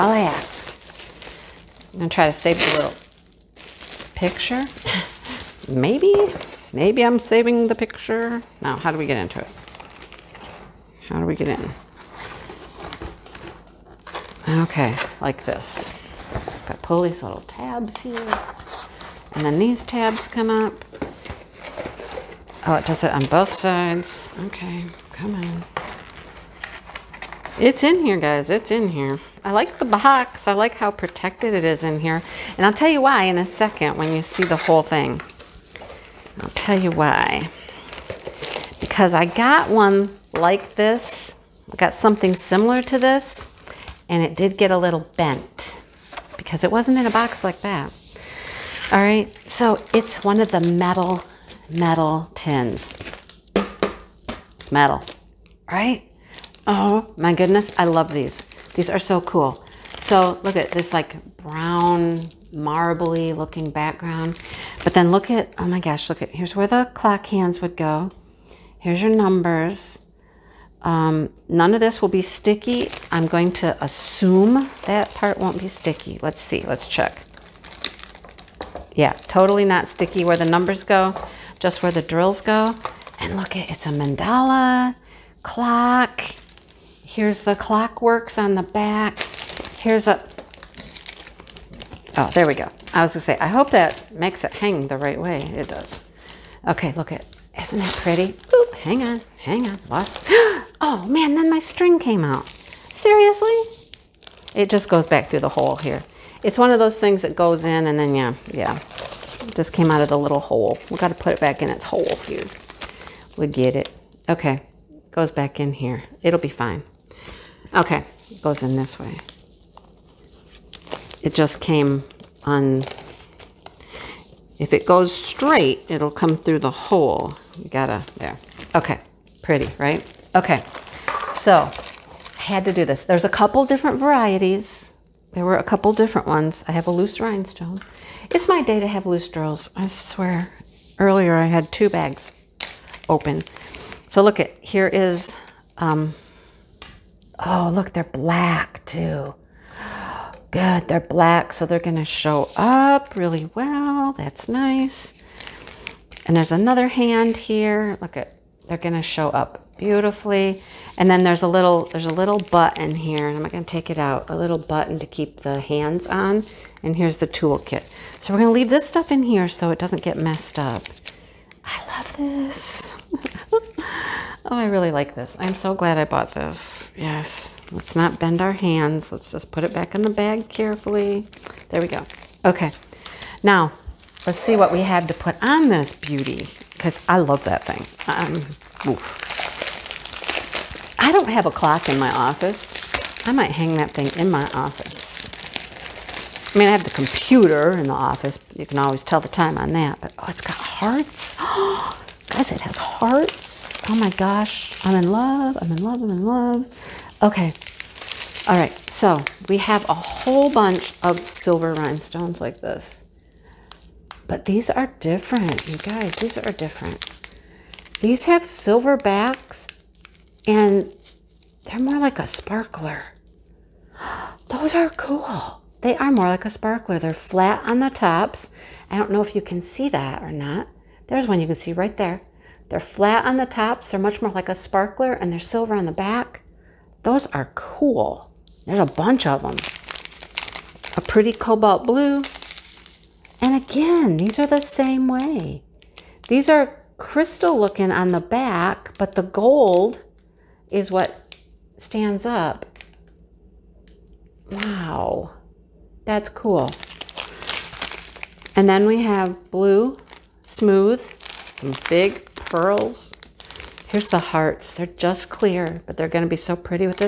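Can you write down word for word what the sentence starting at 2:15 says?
There were a couple different ones.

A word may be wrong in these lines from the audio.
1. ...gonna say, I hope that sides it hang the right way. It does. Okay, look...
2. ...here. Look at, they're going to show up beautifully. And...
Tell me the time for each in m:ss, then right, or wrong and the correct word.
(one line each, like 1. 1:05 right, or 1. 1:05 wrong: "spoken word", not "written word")
1. 1:33 wrong: "makes", not "sides"
2. 2:37 right.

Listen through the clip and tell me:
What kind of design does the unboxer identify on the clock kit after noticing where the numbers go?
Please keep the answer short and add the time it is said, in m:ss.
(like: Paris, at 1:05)
mandala, at 1:23.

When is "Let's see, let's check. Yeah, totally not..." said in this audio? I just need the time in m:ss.
1:16.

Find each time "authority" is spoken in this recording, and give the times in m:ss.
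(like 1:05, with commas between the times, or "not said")
not said.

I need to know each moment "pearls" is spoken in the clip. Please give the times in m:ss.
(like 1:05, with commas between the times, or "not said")
4:22.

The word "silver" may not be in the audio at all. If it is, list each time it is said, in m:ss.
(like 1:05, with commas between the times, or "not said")
3:31, 3:38, 3:55.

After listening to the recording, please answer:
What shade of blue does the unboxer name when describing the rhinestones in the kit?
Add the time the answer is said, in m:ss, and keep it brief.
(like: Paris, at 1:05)
cobalt blue, at 4:01.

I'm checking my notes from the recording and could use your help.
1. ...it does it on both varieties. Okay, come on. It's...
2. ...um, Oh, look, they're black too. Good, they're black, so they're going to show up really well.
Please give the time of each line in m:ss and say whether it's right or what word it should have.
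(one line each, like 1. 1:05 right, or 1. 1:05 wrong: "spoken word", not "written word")
1. 0:22 wrong: "sides", not "varieties"
2. 2:25 right.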